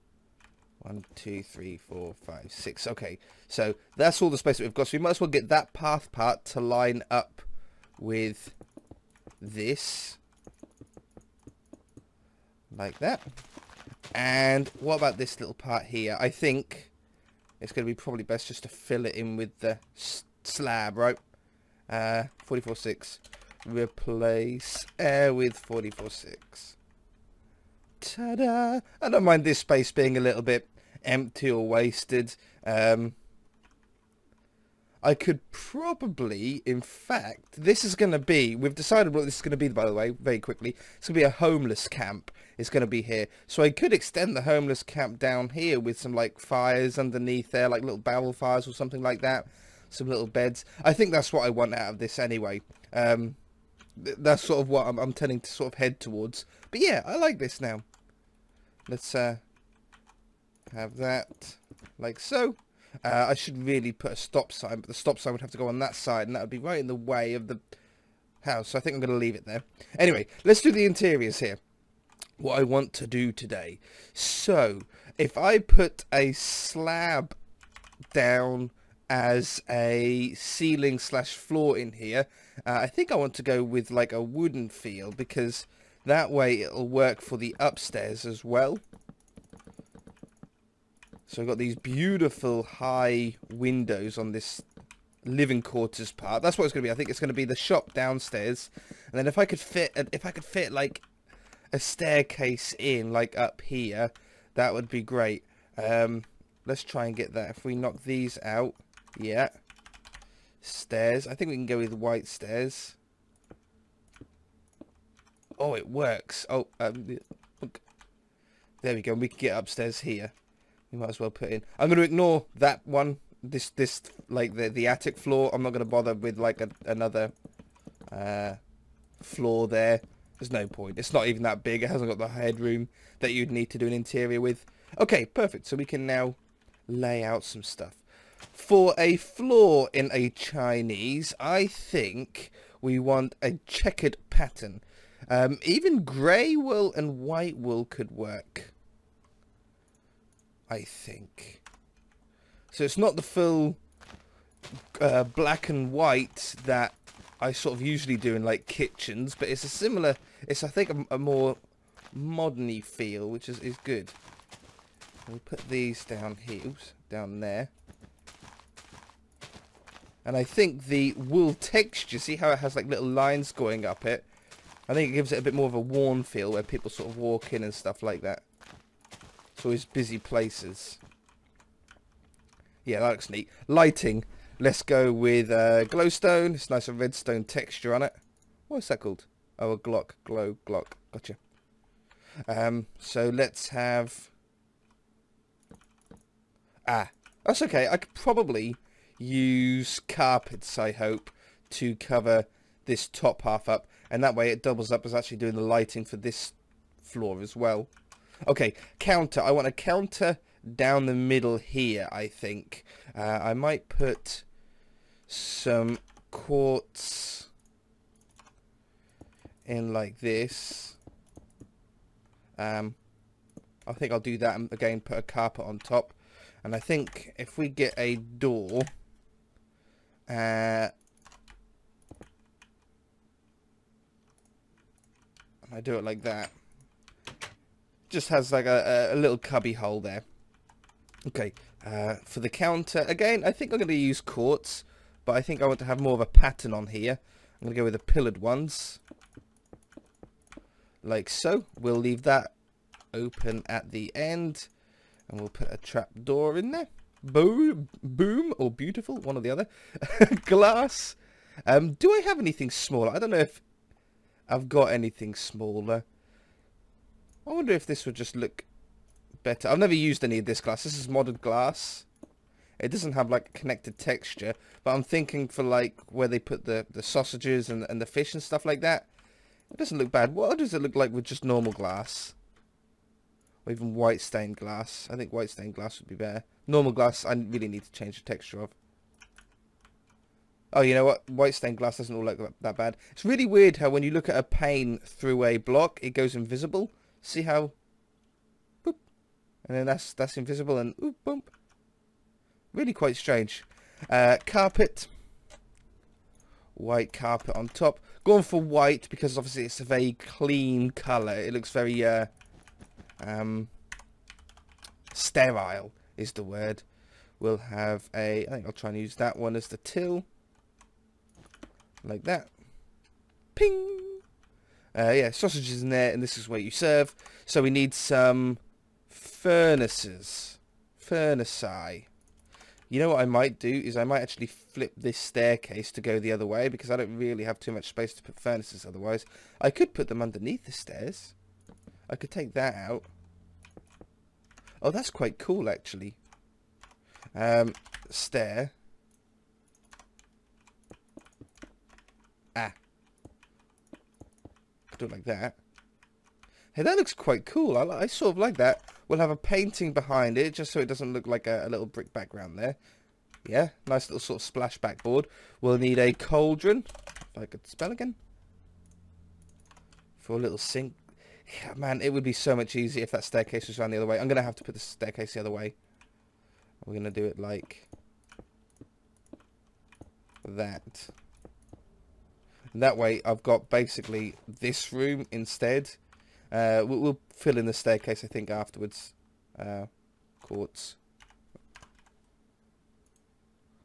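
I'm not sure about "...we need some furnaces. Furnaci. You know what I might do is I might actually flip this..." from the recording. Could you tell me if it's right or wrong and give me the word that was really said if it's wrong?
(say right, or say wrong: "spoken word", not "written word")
right.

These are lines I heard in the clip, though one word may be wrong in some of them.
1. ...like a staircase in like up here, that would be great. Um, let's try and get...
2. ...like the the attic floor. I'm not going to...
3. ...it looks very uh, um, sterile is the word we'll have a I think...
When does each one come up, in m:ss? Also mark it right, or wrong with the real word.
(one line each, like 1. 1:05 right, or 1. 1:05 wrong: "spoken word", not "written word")
1. 1:40 right
2. 2:04 right
3. 5:11 right.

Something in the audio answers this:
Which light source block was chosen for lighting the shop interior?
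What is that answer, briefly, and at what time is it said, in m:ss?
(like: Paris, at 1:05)
Glowstone, at 3:05.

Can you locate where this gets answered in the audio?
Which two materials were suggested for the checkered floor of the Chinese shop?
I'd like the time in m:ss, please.
2:26.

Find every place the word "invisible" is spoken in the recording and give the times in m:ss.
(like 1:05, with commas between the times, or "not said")
4:56, 5:00.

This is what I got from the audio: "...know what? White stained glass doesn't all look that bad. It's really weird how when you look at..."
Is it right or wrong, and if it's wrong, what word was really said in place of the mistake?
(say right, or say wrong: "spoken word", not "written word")
right.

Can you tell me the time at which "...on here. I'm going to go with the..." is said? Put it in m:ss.
4:06.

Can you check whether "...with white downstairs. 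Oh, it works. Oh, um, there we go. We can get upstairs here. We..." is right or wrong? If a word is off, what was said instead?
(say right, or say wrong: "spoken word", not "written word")
wrong: "stairs", not "downstairs".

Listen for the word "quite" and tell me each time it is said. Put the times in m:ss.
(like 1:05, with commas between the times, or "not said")
5:02, 5:45, 5:57.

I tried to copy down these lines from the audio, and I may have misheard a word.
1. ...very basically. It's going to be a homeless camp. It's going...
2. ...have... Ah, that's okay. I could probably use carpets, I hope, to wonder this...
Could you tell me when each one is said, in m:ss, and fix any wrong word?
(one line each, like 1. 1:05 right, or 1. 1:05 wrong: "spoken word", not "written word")
1. 0:40 wrong: "quickly", not "basically"
2. 3:13 wrong: "cover", not "wonder".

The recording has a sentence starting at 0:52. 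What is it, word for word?
Um, th that's sort of what I'm, I'm tending to sort of head towards.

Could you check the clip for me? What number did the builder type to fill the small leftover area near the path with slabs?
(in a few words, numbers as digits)
44.6.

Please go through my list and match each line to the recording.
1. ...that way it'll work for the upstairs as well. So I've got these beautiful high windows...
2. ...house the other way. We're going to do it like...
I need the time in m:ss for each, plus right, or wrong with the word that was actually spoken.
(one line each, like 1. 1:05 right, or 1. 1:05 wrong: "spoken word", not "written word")
1. 1:26 right
2. 6:14 wrong: "staircase", not "house".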